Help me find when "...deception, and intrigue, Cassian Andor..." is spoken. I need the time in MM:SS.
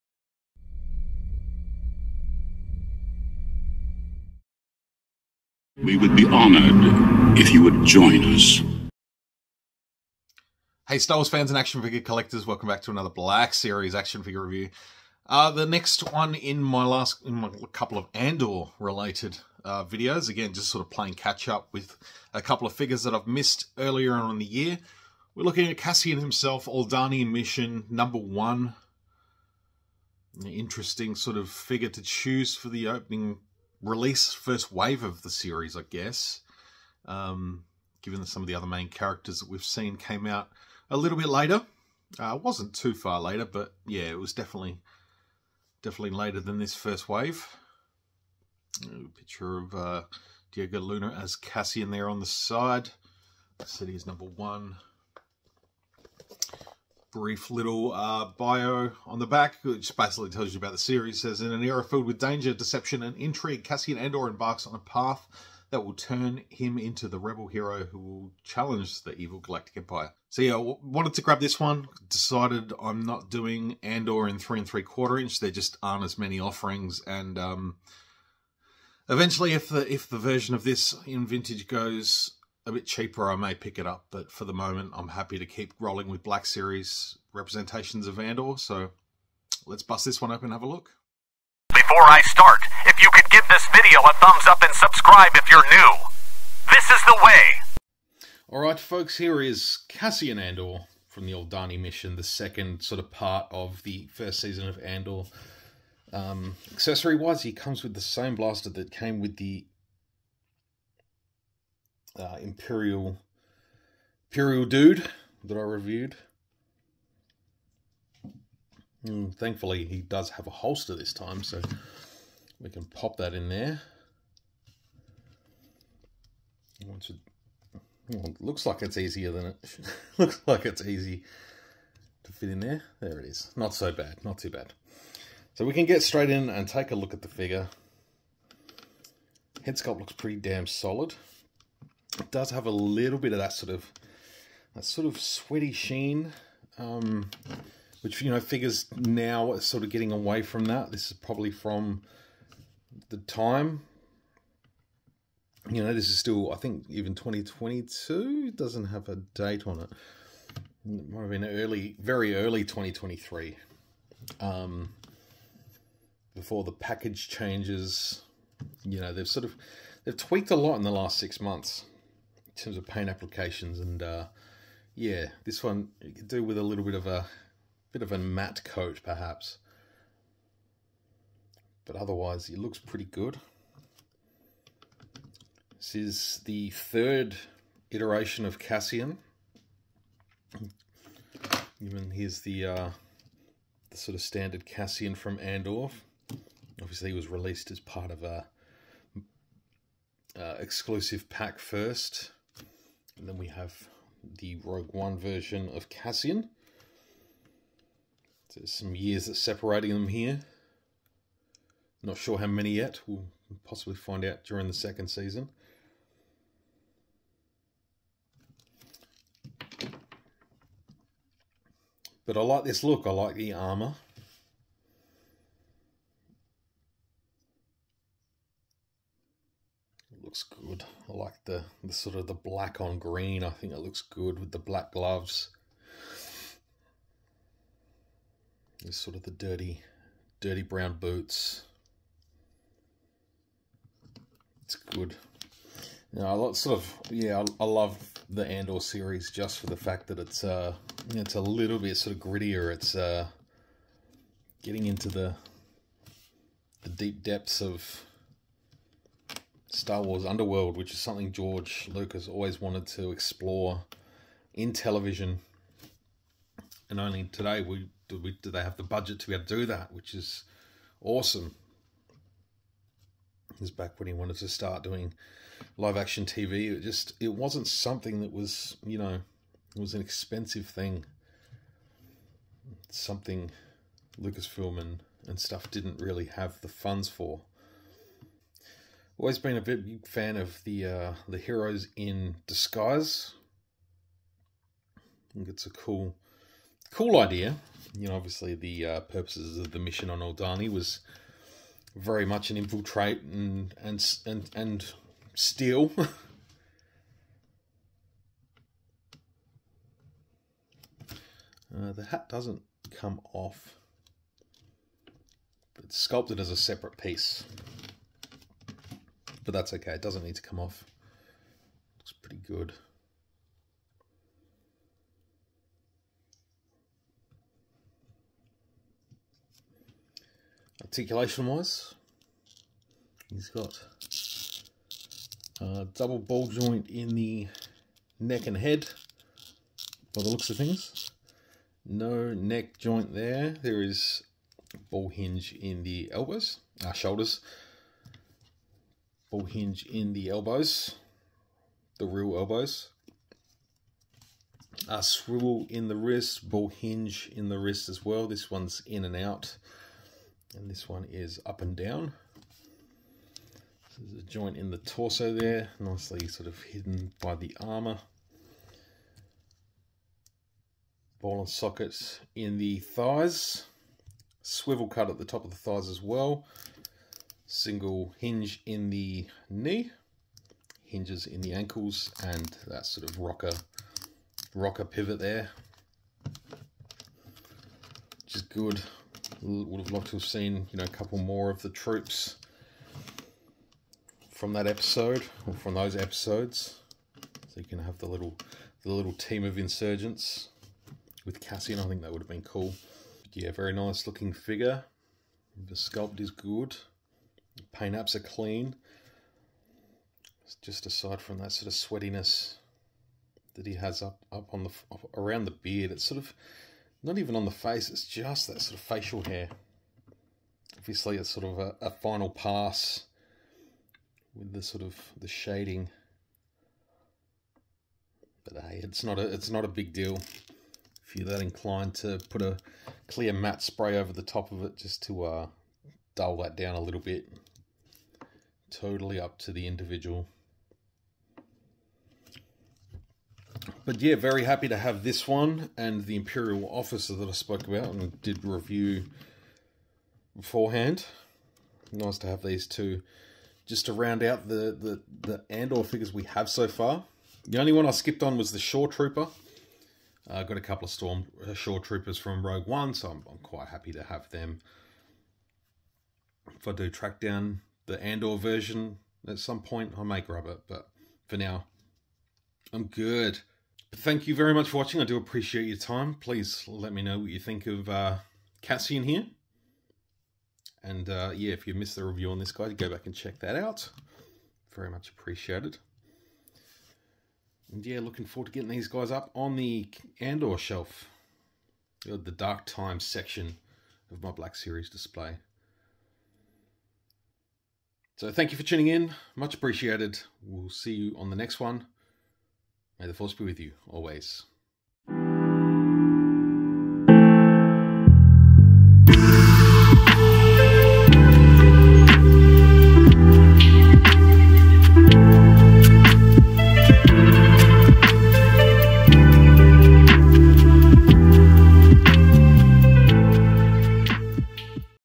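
01:02.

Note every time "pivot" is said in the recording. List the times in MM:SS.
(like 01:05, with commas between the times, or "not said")
06:24.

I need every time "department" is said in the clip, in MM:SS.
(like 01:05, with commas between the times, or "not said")
not said.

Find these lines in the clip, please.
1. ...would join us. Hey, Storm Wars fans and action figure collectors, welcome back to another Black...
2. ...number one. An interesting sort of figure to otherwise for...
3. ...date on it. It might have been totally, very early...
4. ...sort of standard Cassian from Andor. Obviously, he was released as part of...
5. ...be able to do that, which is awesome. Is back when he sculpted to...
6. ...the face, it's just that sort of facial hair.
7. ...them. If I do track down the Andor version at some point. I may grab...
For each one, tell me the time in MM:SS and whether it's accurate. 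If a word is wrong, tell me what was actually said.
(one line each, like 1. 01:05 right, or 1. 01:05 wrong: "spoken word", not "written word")
1. 00:07 wrong: "Star", not "Storm"
2. 00:27 wrong: "choose", not "otherwise"
3. 02:39 wrong: "early", not "totally"
4. 03:13 right
5. 04:29 wrong: "wanted", not "sculpted"
6. 06:57 right
7. 07:44 right.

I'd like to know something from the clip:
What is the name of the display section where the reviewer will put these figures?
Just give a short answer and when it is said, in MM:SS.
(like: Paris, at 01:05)
The Dark Times, at 08:12.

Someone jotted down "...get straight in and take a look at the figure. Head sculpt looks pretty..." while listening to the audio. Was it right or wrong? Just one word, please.
right.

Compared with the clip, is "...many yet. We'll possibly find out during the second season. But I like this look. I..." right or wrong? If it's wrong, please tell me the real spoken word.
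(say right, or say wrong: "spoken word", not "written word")
right.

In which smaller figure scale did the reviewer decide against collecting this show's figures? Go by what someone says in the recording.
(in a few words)
three and three quarter inch.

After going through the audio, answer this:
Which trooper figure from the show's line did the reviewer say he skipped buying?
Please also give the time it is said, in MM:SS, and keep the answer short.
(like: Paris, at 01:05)
Shore Trooper, at 07:38.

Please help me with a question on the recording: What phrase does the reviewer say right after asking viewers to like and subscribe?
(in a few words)
This is the way.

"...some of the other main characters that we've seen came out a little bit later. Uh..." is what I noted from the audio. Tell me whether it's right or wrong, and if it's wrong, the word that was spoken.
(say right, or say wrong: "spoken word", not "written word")
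right.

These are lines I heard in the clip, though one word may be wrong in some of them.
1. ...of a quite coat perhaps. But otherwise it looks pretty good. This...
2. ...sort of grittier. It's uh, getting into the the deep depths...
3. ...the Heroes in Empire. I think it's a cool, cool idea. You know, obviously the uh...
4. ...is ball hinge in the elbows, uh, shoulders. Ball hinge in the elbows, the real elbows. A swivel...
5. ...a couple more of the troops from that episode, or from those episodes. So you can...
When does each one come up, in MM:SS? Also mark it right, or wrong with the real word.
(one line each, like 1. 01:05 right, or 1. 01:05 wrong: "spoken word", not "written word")
1. 02:58 wrong: "matte", not "quite"
2. 04:11 right
3. 04:51 wrong: "Disguise", not "Empire"
4. 05:43 right
5. 06:30 right.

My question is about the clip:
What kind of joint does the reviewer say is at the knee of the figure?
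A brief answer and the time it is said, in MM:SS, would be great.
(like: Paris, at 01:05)
single hinge, at 06:17.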